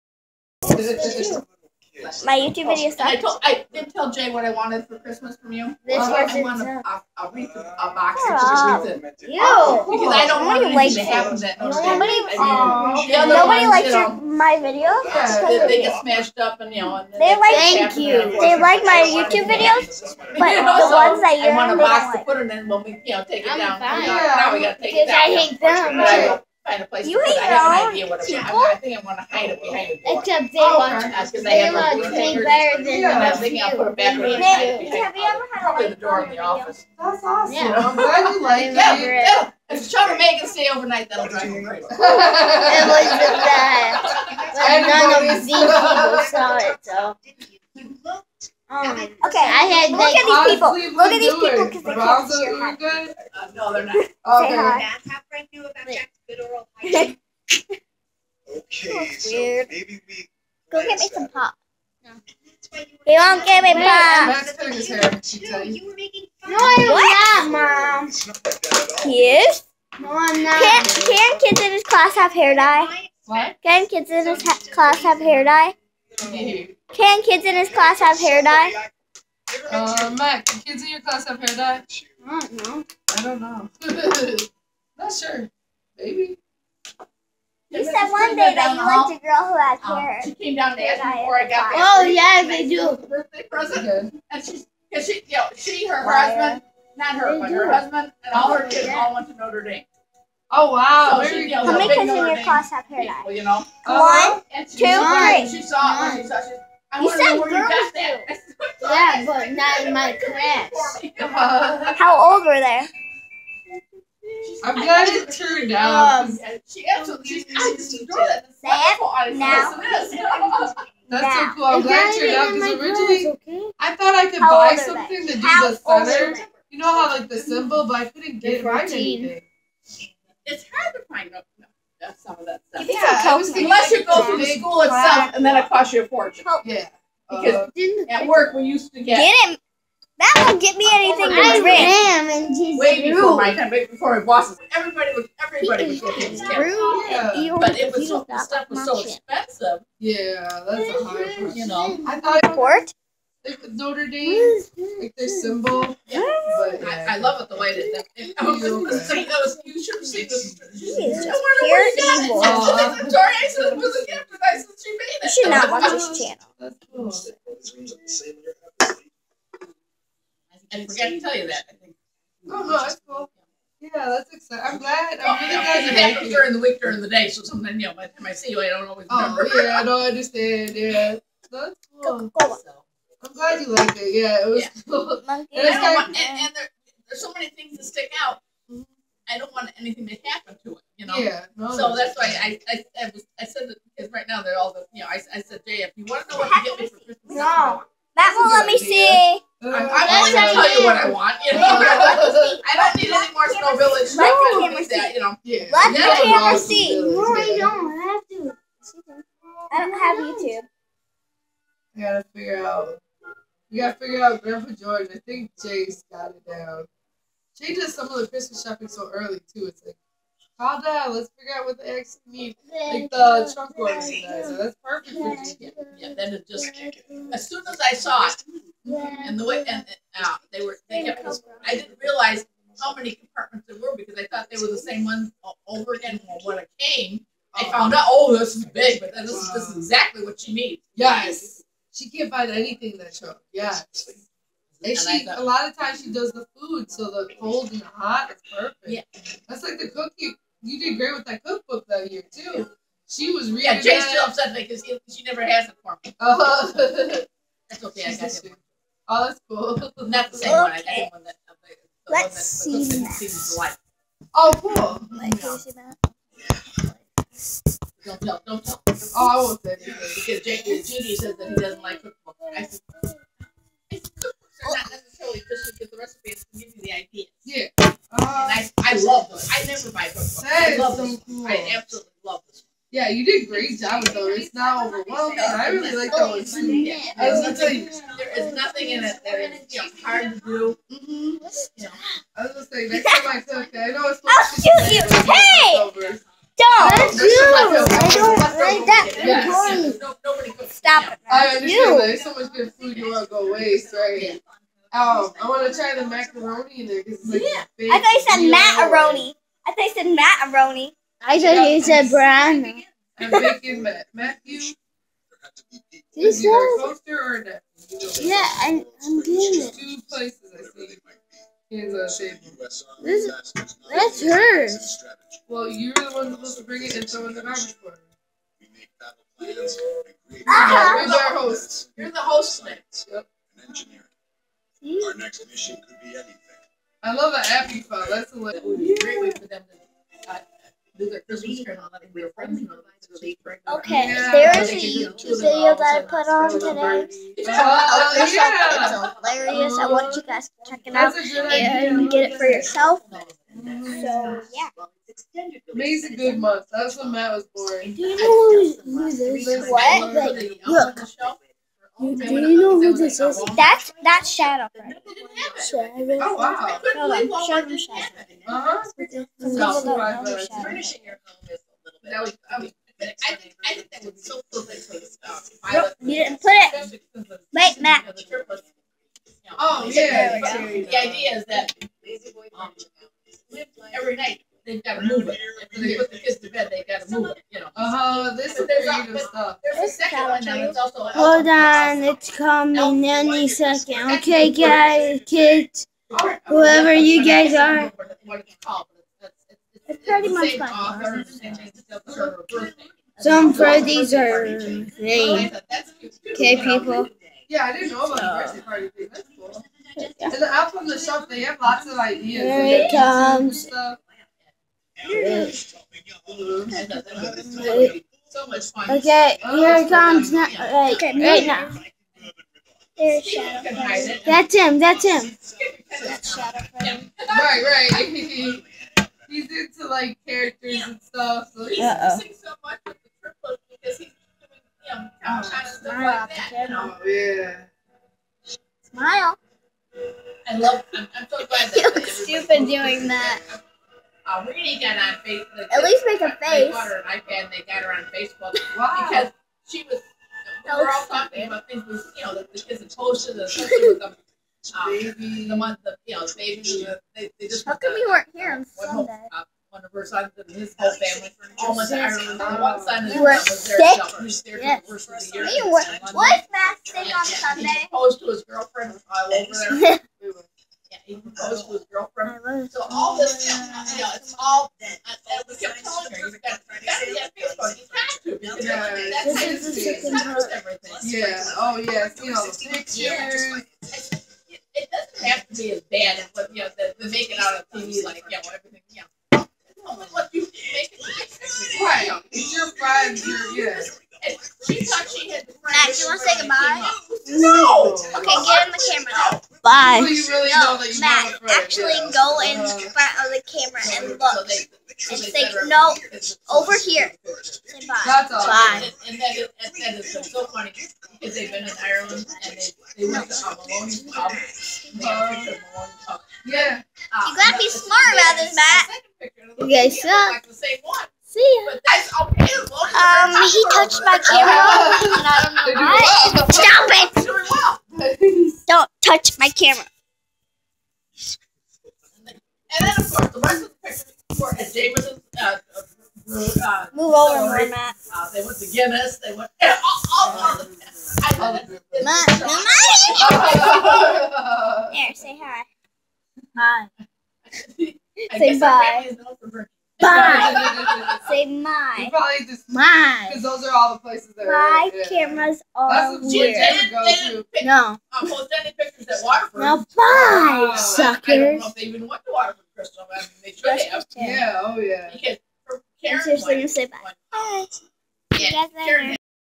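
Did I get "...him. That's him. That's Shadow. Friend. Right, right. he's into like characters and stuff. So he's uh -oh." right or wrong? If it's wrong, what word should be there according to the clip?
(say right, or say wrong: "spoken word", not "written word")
right.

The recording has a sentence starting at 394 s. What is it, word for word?
Okay, guys, kids, whoever you guys are.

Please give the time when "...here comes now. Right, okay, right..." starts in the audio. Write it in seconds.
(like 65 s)
419 s.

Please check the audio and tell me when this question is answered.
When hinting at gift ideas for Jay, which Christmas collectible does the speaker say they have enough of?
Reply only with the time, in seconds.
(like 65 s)
203 s.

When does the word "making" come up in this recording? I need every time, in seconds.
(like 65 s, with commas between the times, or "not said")
176 s, 313 s.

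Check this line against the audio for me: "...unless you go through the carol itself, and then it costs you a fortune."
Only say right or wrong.
wrong.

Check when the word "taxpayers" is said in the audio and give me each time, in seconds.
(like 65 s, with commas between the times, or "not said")
not said.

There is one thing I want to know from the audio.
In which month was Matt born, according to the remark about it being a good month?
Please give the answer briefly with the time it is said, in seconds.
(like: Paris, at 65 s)
May, at 355 s.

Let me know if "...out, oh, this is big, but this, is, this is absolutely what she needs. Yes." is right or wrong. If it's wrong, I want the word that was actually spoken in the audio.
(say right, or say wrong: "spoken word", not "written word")
wrong: "exactly", not "absolutely".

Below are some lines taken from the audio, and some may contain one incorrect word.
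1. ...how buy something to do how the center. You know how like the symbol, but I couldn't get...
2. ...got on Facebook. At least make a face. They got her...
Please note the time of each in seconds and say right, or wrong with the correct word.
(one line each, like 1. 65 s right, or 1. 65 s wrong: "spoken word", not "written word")
1. 124 s right
2. 444 s right.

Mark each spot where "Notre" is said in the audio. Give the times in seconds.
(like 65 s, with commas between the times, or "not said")
99 s, 153 s.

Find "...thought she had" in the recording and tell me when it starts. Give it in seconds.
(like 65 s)
494 s.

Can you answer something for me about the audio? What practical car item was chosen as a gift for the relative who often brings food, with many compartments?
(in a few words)
trunk organizer.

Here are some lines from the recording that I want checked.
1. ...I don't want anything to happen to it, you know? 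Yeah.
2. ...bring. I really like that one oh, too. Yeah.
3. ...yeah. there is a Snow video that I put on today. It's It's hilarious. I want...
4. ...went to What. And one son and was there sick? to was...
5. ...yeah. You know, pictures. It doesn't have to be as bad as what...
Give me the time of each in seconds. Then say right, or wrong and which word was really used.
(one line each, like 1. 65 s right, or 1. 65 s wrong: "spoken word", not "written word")
1. 189 s right
2. 284 s wrong: "overwhelming", not "bring"
3. 344 s wrong: "YouTube", not "Snow"
4. 461 s wrong: "Ireland", not "What"
5. 481 s right.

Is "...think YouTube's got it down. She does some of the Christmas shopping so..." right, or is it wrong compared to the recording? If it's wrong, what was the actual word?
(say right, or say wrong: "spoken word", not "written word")
wrong: "Jay", not "YouTube".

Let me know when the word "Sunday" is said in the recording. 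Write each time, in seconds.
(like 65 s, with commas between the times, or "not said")
458 s, 467 s.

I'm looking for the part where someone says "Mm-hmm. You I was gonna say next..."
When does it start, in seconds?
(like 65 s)
290 s.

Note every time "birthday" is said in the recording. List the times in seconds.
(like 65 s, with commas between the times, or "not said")
93 s, 408 s.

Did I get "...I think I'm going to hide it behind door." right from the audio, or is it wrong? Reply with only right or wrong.
right.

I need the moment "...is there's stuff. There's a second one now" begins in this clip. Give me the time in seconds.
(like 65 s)
388 s.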